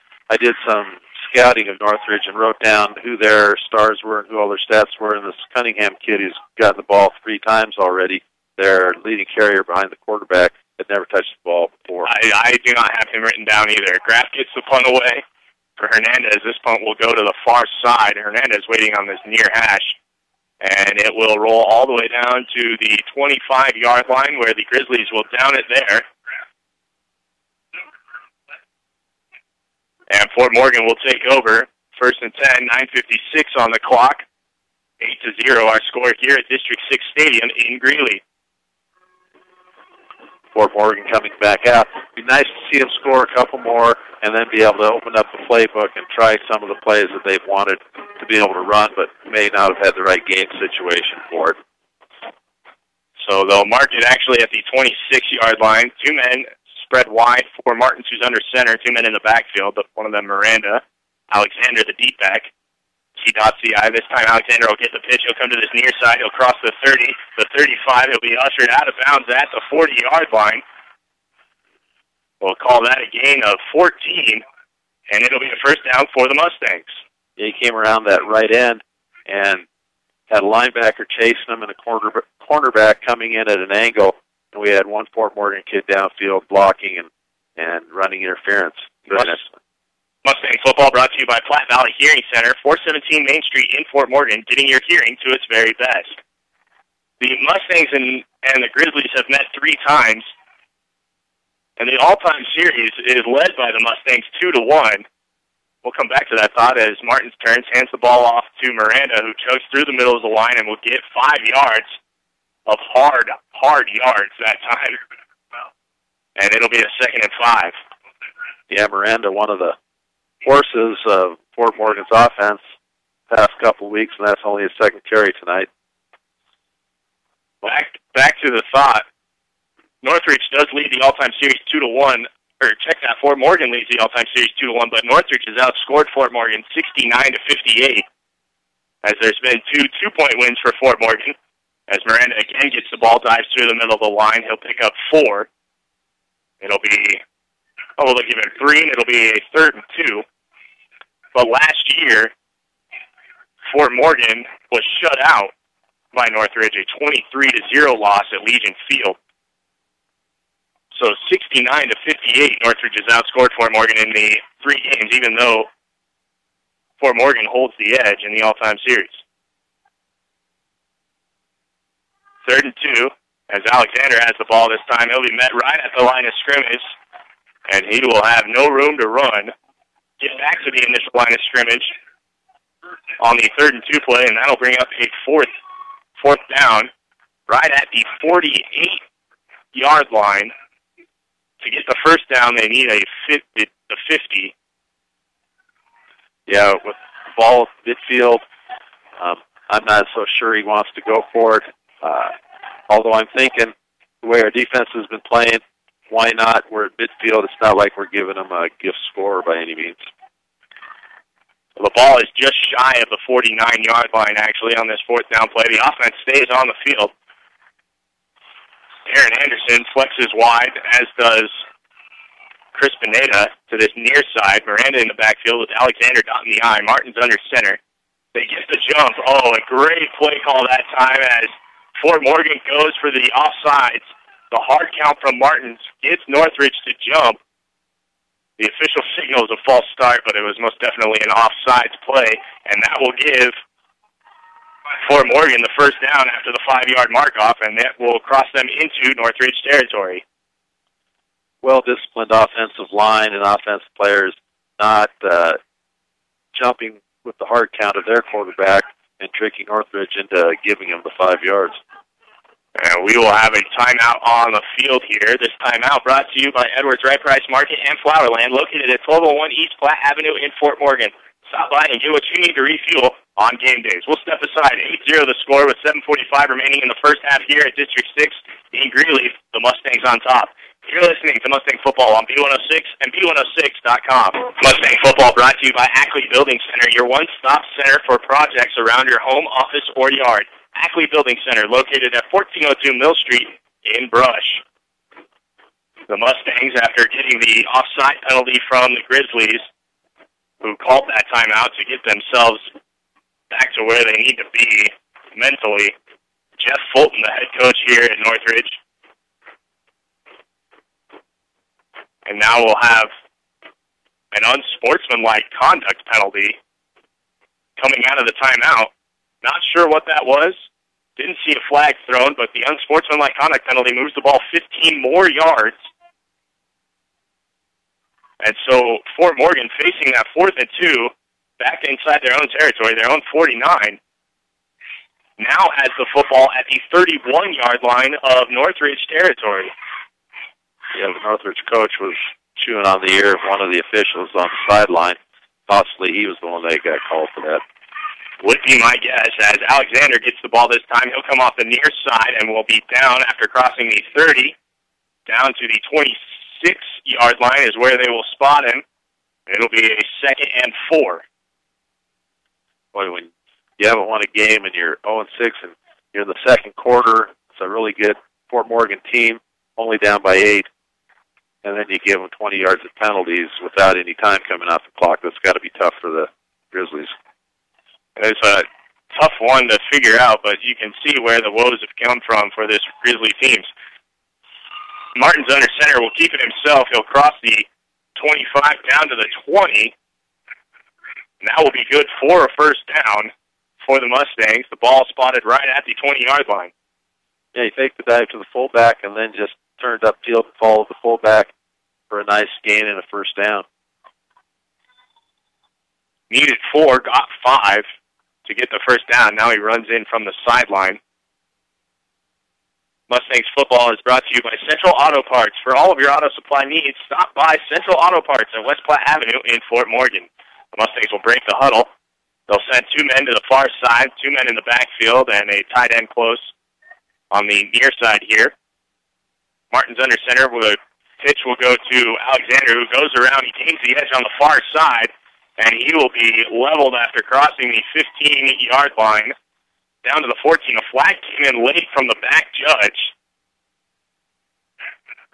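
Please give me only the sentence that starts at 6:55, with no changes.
For all of your auto supply needs, stop by Central Auto Parts at West Platte Avenue in Fort Morgan.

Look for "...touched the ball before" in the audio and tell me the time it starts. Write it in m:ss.
0:11.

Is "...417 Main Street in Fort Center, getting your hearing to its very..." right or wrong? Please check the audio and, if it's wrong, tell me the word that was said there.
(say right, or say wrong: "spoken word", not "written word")
wrong: "Morgan", not "Center".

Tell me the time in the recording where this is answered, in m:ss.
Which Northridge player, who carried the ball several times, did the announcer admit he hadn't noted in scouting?
0:05.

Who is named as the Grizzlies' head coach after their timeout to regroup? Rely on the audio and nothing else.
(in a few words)
Jeff Fulton.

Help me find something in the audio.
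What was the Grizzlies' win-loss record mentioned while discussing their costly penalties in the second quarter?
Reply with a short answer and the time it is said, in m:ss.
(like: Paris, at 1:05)
0 and 6, at 6:05.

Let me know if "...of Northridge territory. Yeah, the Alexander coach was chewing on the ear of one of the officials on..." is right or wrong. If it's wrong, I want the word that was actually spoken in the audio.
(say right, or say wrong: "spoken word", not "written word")
wrong: "Northridge", not "Alexander".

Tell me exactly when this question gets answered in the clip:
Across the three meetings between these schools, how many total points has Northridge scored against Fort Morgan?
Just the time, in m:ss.
2:16.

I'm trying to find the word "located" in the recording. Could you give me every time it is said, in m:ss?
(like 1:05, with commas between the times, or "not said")
4:28, 4:51.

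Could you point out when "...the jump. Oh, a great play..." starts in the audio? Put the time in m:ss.
3:48.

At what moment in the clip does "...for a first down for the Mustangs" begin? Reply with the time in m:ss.
6:32.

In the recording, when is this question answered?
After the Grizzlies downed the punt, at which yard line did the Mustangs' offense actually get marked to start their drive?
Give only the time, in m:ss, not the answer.
0:54.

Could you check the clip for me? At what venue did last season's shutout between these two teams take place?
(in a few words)
Legion Field.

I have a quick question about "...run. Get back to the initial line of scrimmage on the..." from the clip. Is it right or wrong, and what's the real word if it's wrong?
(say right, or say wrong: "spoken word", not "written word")
right.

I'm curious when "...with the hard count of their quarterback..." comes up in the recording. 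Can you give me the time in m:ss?
4:17.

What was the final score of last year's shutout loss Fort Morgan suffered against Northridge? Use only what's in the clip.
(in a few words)
23 to 0.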